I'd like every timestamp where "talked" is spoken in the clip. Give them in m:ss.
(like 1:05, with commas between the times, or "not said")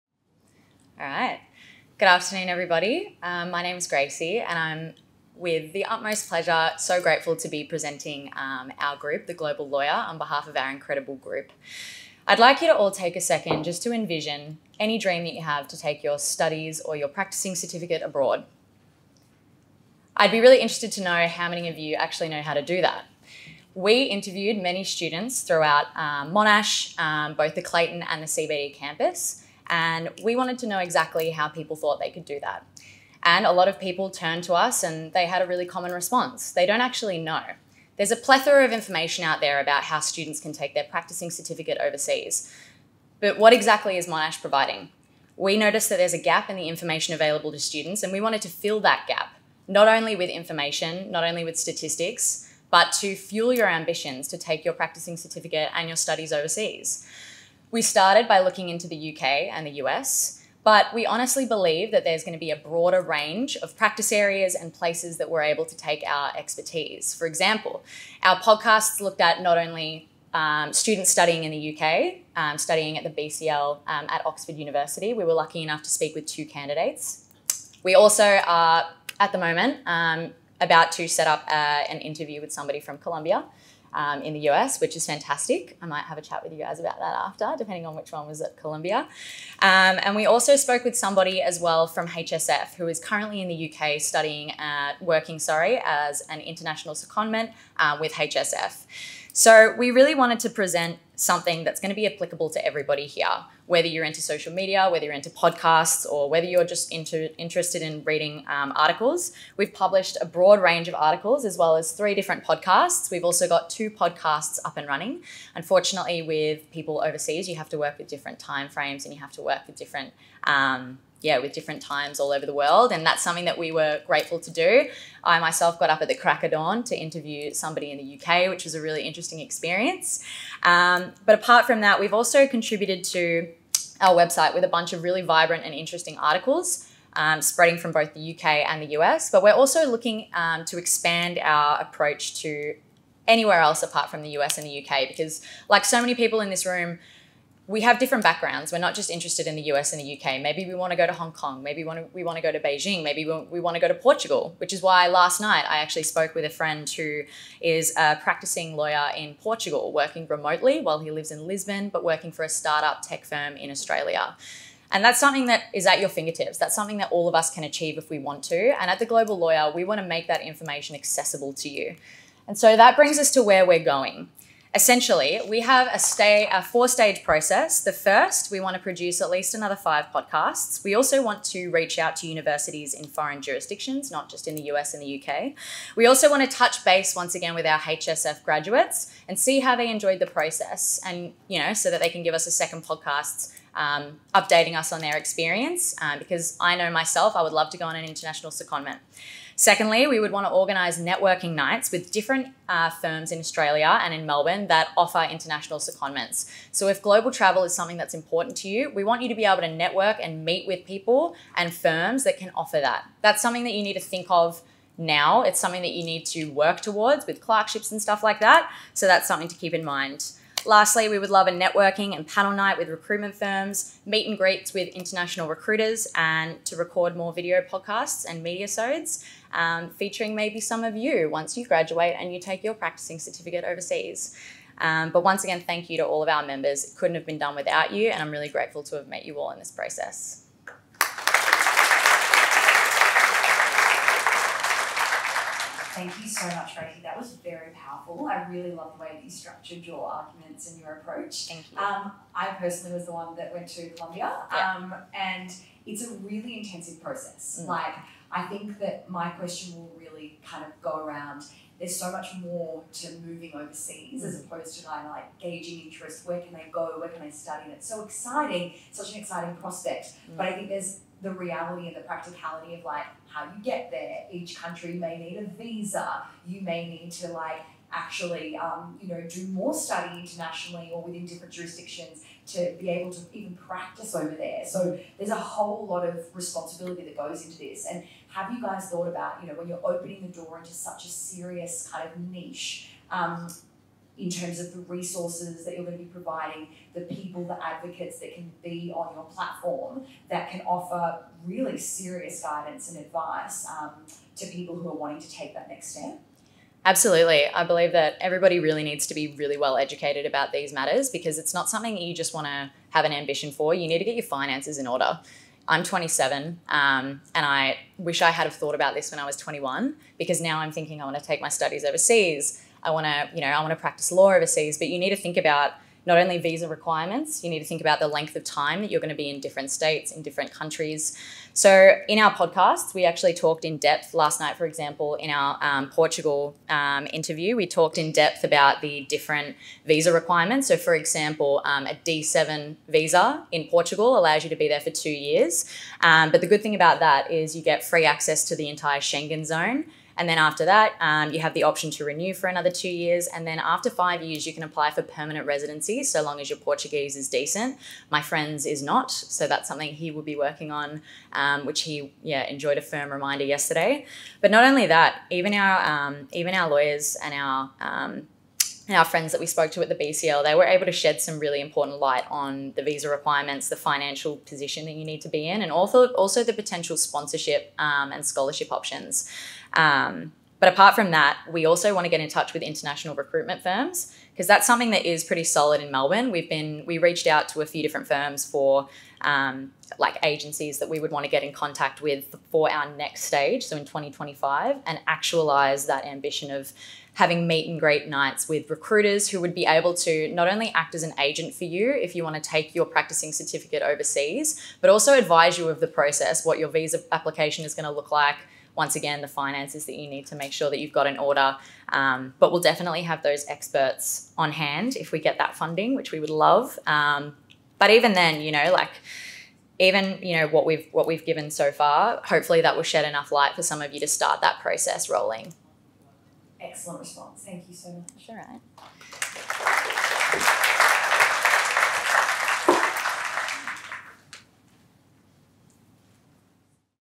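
5:33, 5:37.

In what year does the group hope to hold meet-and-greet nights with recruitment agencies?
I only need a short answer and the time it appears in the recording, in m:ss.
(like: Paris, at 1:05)
2025, at 6:33.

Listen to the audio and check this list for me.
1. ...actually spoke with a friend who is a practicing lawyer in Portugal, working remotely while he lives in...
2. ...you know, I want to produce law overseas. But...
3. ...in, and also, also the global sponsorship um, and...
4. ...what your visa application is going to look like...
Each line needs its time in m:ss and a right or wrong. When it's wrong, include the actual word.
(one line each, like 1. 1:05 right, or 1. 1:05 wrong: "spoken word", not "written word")
1. 2:35 right
2. 5:23 wrong: "practice", not "produce"
3. 6:15 wrong: "potential", not "global"
4. 6:46 right.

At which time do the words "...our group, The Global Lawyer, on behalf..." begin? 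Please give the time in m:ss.
0:08.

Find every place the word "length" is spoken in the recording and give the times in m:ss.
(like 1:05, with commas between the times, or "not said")
5:28.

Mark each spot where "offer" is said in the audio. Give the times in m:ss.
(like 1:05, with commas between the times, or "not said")
3:24, 3:32, 5:00.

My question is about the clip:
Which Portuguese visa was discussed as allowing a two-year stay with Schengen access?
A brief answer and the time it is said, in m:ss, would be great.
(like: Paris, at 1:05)
D7, at 5:42.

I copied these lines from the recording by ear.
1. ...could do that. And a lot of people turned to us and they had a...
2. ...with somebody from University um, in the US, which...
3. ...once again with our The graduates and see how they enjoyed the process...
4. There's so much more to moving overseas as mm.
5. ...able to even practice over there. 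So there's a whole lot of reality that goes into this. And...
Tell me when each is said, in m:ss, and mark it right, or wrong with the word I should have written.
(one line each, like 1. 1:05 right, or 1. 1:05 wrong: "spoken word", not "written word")
1. 0:32 right
2. 1:22 wrong: "Columbia", not "University"
3. 3:07 wrong: "HSF", not "The"
4. 4:21 right
5. 4:42 wrong: "responsibility", not "reality".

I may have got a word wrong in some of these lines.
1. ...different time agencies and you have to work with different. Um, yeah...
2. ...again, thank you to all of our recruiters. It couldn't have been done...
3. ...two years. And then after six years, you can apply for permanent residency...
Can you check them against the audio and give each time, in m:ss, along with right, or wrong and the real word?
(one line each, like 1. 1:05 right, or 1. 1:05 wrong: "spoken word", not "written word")
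1. 1:58 wrong: "frames", not "agencies"
2. 3:55 wrong: "members", not "recruiters"
3. 5:52 wrong: "five", not "six".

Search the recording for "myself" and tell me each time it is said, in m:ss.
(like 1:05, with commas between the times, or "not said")
2:05, 3:16.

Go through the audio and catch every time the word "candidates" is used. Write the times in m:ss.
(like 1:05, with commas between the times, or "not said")
1:16.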